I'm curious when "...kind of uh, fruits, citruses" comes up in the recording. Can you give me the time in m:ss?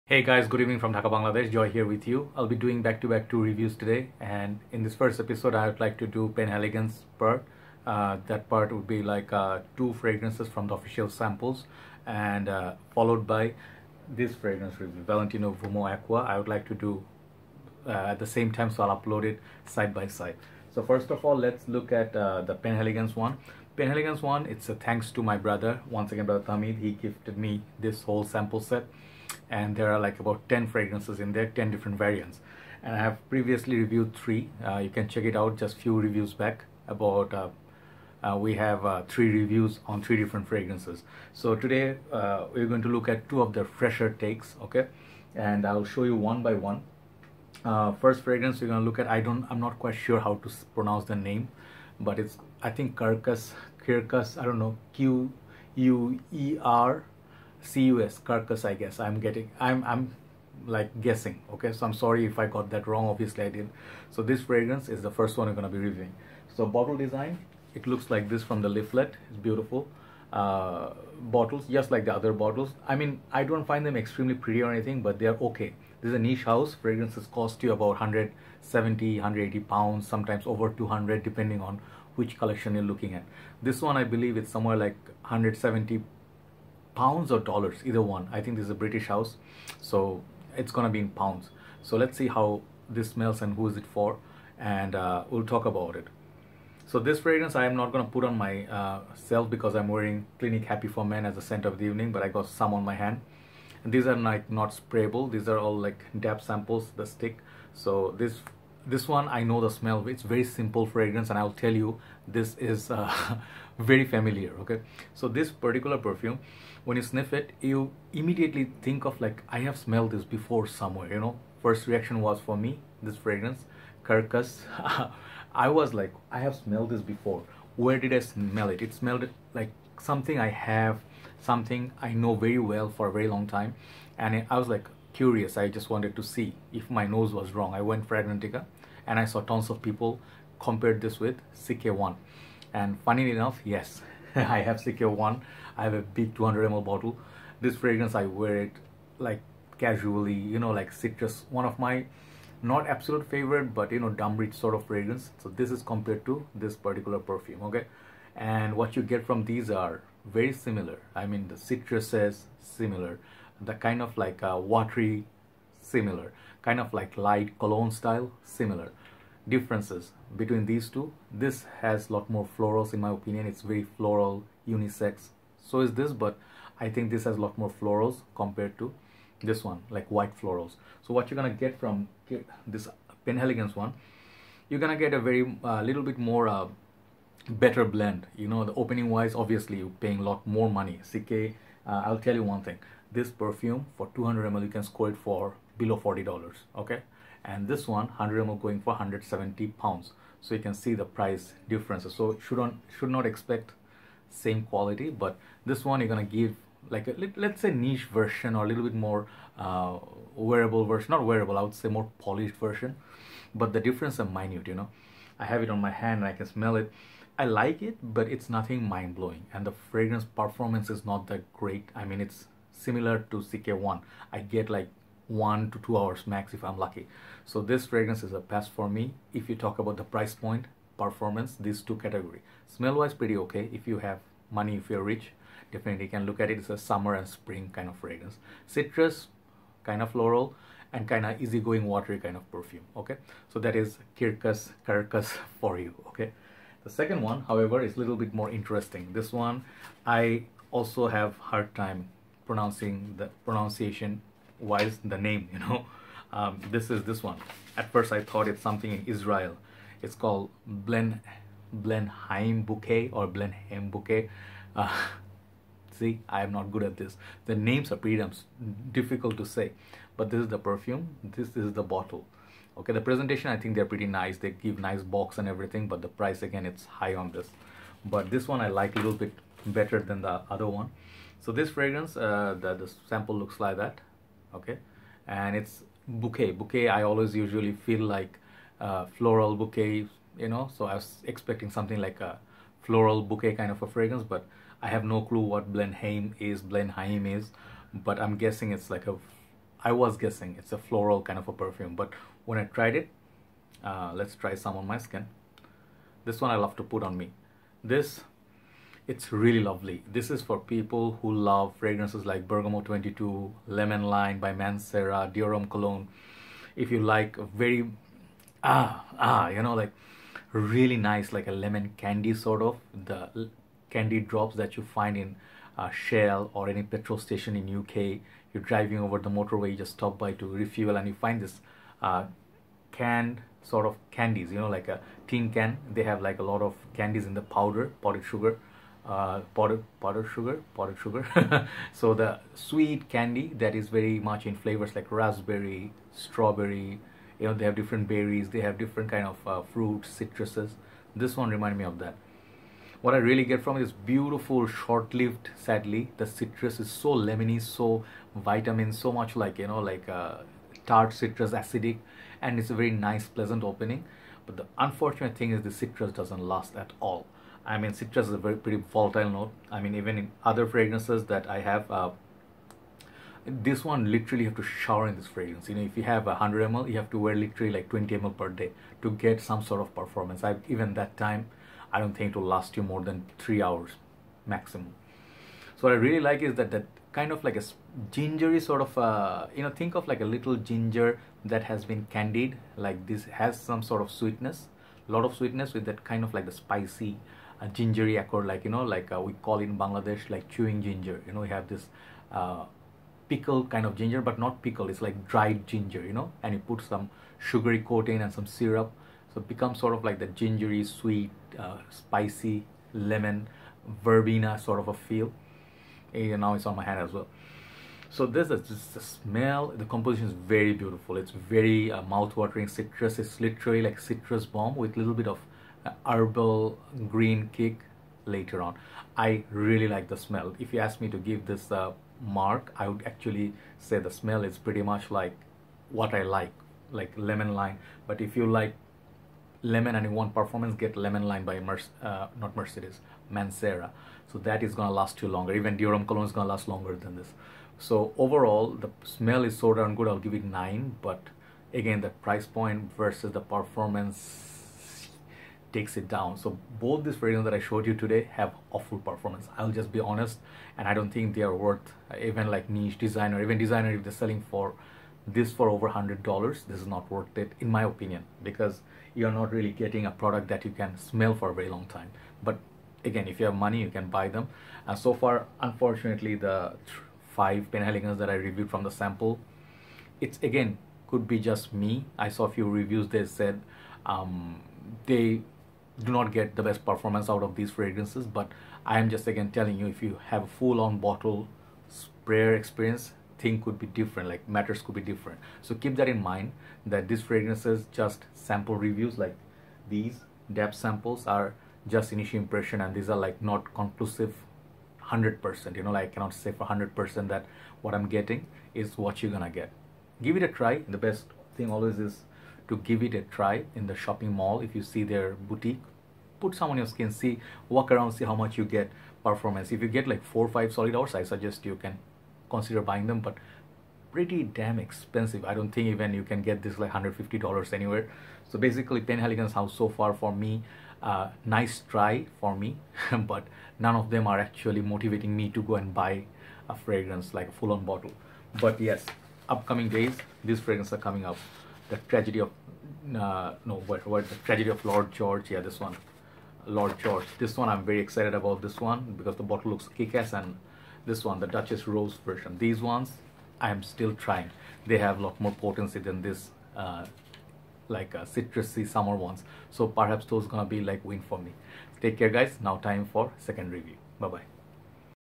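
5:49.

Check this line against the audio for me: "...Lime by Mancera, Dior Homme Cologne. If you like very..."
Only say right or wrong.
right.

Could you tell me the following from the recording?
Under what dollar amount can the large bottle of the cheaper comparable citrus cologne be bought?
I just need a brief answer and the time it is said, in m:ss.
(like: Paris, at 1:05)
$40, at 3:15.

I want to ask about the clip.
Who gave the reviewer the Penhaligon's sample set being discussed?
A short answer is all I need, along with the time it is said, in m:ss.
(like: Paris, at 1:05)
Tahmid, at 0:26.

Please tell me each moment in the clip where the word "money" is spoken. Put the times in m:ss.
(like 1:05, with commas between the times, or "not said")
3:10, 3:54, 7:53.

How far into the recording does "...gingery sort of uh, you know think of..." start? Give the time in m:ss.
6:28.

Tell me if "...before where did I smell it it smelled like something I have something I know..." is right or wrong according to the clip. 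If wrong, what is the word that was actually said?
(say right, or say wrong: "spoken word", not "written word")
right.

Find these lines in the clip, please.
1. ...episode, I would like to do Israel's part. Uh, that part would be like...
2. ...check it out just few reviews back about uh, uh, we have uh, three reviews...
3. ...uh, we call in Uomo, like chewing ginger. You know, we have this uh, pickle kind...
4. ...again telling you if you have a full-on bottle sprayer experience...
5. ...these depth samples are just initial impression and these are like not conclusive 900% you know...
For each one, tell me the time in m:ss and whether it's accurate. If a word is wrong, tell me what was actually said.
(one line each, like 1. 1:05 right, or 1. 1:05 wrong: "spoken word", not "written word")
1. 0:05 wrong: "Penhaligon", not "Israel"
2. 0:35 right
3. 6:39 wrong: "Bangladesh", not "Uomo"
4. 8:09 right
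5. 8:19 wrong: "100", not "900".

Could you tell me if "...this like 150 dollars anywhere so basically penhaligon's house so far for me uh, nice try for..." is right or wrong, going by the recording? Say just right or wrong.
right.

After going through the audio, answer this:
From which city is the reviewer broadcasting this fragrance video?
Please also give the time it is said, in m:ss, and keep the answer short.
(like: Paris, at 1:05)
Dhaka, at 0:00.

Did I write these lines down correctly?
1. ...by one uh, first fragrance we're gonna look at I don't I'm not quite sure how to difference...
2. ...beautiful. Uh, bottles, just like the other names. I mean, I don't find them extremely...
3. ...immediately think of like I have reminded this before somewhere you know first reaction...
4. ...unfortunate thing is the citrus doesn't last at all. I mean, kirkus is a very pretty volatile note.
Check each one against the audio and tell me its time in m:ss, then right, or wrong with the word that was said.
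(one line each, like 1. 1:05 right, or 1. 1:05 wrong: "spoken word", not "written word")
1. 0:46 wrong: "pronounce", not "difference"
2. 1:09 wrong: "bottles", not "names"
3. 1:58 wrong: "smelled", not "reminded"
4. 6:04 wrong: "citrus", not "kirkus".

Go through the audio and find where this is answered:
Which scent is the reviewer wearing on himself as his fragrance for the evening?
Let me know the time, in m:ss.
1:40.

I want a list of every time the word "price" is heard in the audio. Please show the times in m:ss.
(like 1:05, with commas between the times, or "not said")
3:21, 3:50, 4:36, 7:32.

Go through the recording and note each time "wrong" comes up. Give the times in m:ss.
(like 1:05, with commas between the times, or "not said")
1:02, 2:17.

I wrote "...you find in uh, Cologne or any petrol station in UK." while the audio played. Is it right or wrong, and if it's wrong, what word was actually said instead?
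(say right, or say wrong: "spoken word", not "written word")
wrong: "Shell", not "Cologne".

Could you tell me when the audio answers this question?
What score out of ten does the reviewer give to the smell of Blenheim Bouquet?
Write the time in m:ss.
7:30.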